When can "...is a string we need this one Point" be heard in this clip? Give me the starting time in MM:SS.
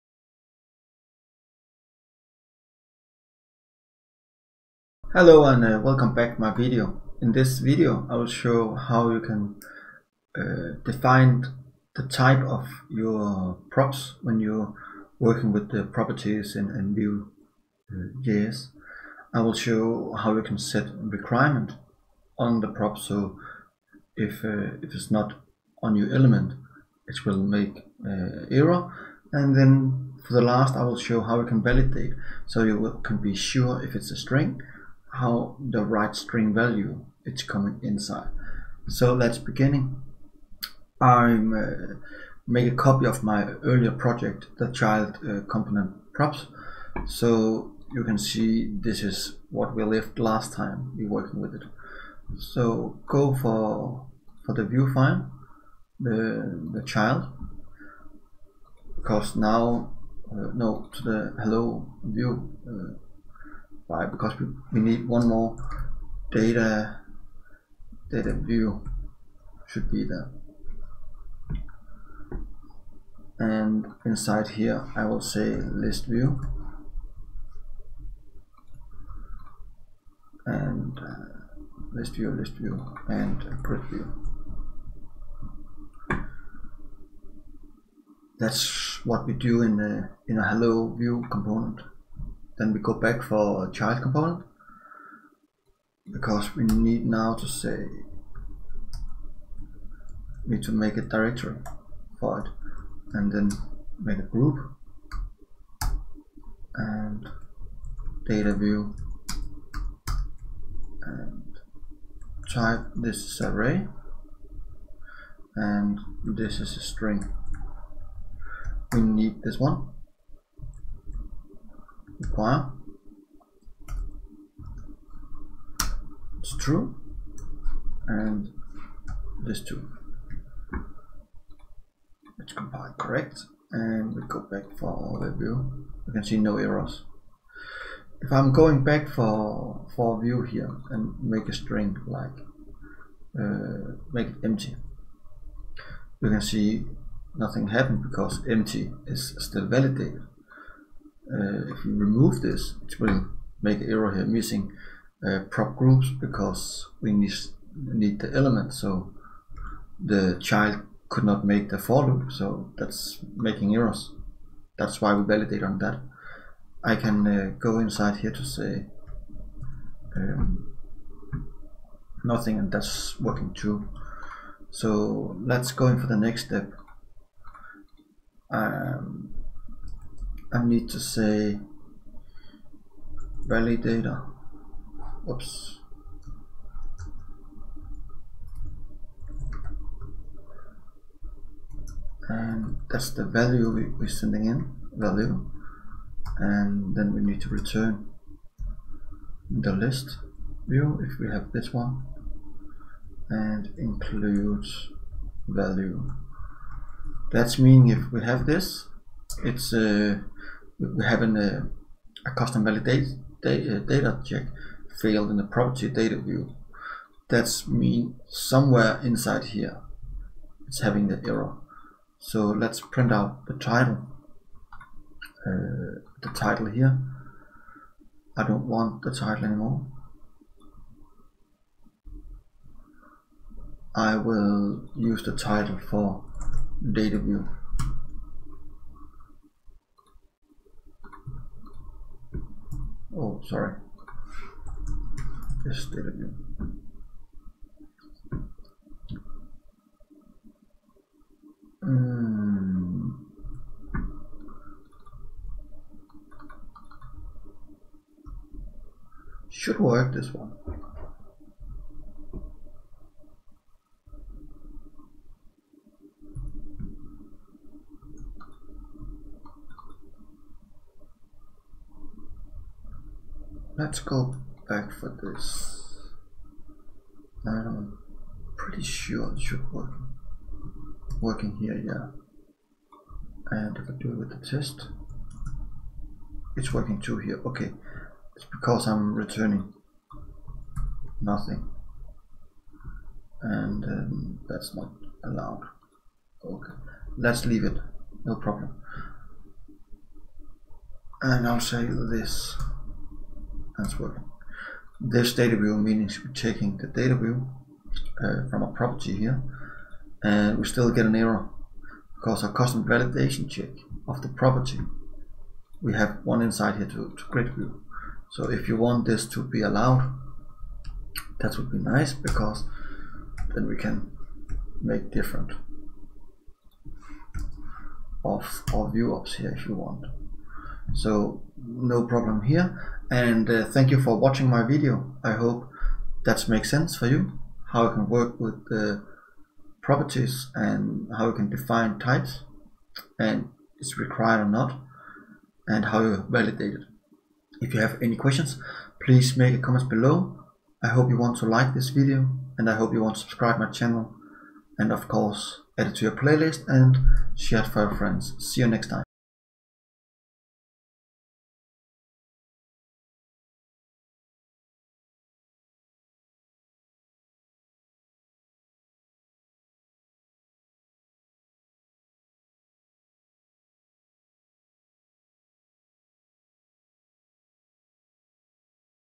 01:56.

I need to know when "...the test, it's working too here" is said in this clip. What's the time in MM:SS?
04:44.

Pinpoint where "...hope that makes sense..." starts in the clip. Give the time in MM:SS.
05:35.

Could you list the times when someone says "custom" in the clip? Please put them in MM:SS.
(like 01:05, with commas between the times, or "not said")
03:32, 05:12.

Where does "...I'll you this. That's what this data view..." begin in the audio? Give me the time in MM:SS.
05:01.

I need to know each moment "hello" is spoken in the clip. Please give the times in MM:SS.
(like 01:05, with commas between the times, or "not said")
00:05, 01:01, 01:30.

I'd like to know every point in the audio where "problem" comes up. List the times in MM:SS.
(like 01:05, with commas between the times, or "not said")
04:58, 05:32.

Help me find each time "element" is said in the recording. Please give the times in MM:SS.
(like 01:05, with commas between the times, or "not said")
00:26, 02:38.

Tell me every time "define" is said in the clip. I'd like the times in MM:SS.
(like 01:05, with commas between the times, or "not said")
00:10, 05:41.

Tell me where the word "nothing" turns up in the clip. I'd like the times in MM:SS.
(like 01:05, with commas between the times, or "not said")
02:27, 02:52, 04:51.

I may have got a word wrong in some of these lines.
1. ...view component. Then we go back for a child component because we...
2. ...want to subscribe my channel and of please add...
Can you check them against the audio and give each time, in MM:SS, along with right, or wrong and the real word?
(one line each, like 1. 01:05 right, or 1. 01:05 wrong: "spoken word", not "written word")
1. 01:30 right
2. 05:53 wrong: "course", not "please".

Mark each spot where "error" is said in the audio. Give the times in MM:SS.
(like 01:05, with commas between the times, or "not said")
00:28, 02:16, 02:33, 02:43, 03:41, 05:11.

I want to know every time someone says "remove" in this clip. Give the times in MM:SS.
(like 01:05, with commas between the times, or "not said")
02:31.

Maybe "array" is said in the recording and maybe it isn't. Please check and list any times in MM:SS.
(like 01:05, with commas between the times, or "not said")
01:53.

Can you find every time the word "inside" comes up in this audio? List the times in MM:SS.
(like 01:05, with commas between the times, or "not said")
00:37, 01:14, 02:47, 03:39, 05:16.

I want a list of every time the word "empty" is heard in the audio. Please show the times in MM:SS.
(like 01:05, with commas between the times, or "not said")
02:24, 02:28.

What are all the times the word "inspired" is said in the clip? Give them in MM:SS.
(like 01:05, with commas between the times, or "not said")
not said.